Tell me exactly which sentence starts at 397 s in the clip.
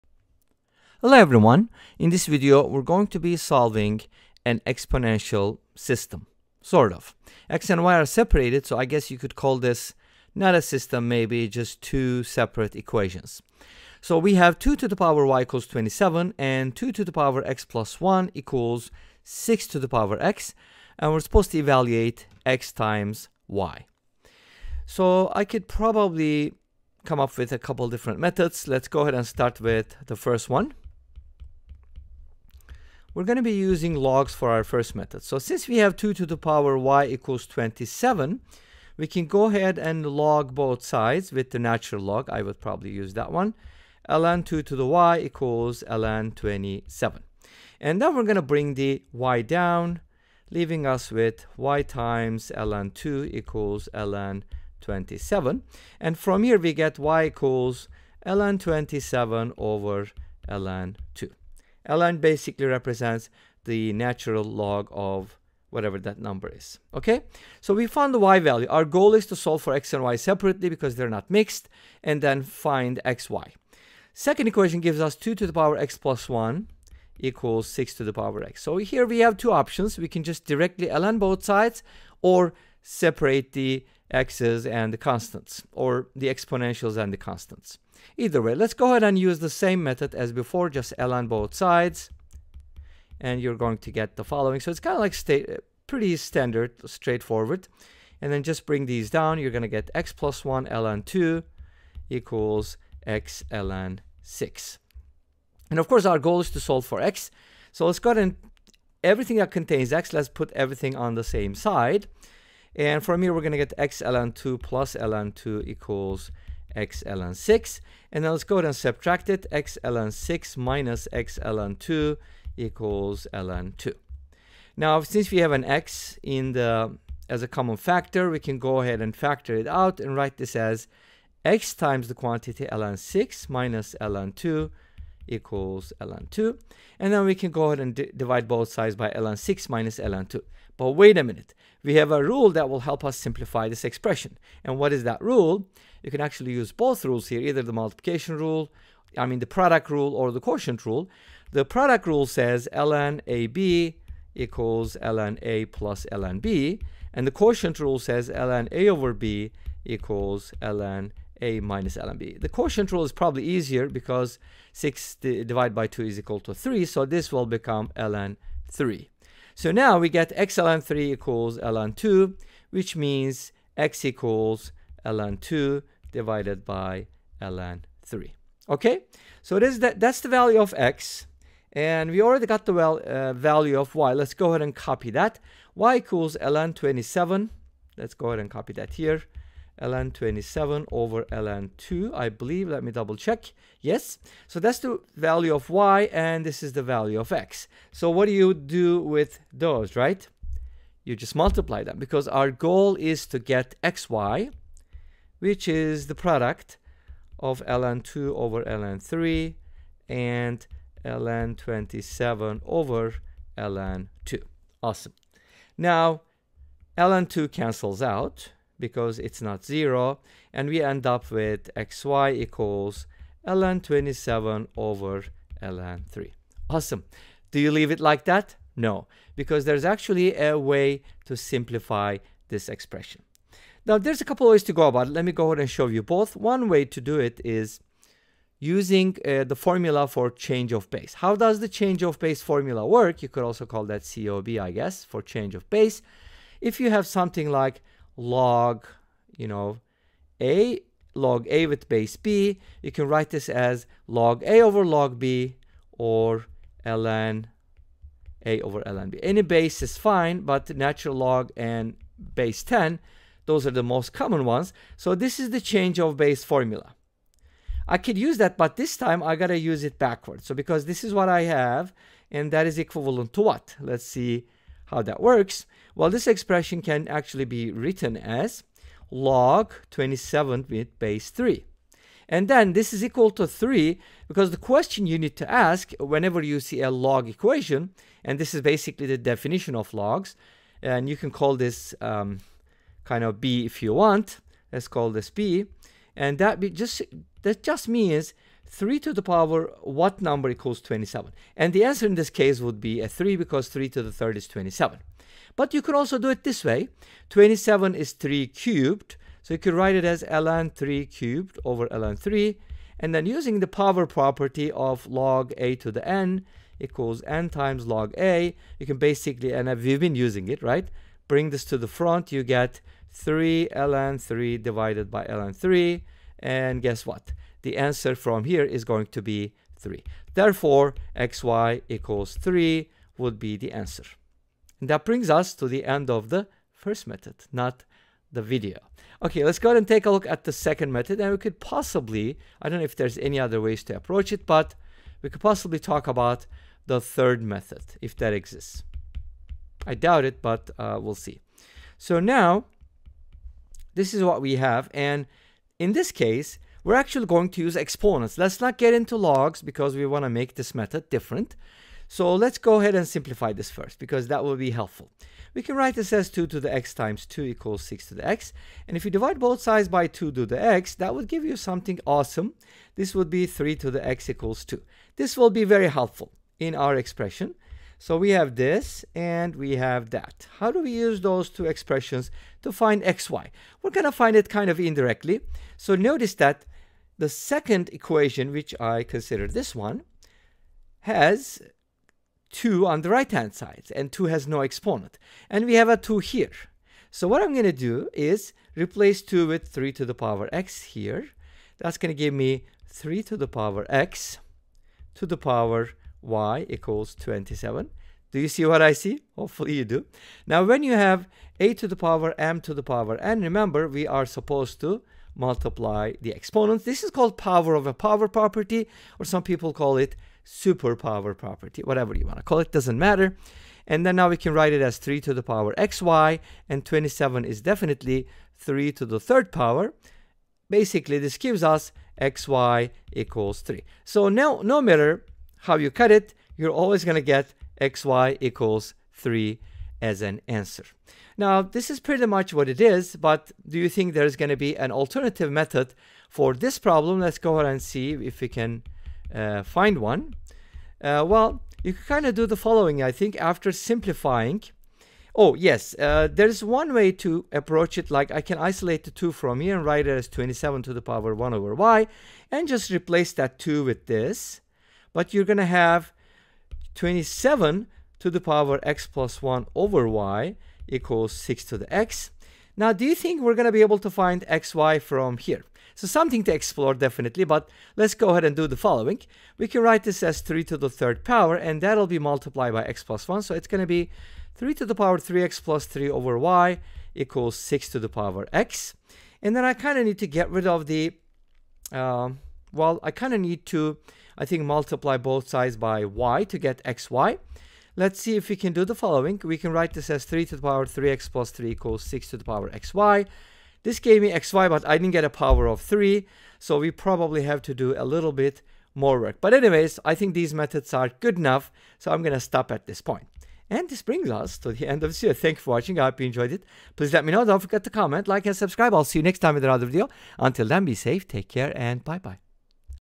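So what I'm going to do is replace 2 with 3 to the power x here.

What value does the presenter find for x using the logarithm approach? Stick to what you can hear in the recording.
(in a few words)
ln 2 / ln 3.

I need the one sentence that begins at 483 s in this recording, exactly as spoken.
So it's going to be 3 to the power 3x plus 3 over y equals 6 to the power x.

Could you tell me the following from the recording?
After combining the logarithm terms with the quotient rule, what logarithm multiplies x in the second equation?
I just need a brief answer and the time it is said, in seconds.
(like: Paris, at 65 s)
ln 3, at 170 s.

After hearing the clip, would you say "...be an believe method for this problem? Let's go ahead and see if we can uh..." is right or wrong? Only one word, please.
wrong.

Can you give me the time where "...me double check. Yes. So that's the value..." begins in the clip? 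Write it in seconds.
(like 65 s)
192 s.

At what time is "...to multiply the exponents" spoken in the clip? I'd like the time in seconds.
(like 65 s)
414 s.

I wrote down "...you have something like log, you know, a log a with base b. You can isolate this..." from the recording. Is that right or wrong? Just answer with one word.
wrong.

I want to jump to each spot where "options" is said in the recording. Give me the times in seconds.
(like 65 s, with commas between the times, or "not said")
79 s.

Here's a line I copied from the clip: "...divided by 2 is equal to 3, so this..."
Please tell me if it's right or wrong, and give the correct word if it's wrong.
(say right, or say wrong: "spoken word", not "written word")
right.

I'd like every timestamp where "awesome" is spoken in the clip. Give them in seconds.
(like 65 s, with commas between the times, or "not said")
214 s, 226 s, 372 s.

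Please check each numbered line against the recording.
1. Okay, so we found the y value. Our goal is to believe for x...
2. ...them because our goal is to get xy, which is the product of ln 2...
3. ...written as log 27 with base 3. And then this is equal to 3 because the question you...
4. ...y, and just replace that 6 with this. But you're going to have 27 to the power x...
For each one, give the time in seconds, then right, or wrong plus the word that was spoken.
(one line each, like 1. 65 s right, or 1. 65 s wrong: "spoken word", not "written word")
1. 66 s wrong: "solve", not "believe"
2. 201 s right
3. 277 s right
4. 461 s wrong: "2", not "6".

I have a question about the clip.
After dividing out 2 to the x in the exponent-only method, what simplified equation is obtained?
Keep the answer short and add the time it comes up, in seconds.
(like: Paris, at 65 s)
3^x = 2, at 373 s.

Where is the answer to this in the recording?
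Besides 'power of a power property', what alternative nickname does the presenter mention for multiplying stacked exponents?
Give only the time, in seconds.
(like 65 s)
420 s.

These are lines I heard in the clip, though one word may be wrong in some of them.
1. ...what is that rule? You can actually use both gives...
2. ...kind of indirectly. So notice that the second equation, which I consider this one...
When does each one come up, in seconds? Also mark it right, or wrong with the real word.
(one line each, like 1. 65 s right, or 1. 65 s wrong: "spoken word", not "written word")
1. 144 s wrong: "rules", not "gives"
2. 384 s right.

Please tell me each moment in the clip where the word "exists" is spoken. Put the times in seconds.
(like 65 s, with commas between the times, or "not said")
348 s.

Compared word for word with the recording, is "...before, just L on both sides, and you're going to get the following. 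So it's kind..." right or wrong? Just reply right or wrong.
right.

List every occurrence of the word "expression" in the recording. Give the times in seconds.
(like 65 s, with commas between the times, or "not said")
143 s, 232 s, 276 s, 376 s, 381 s.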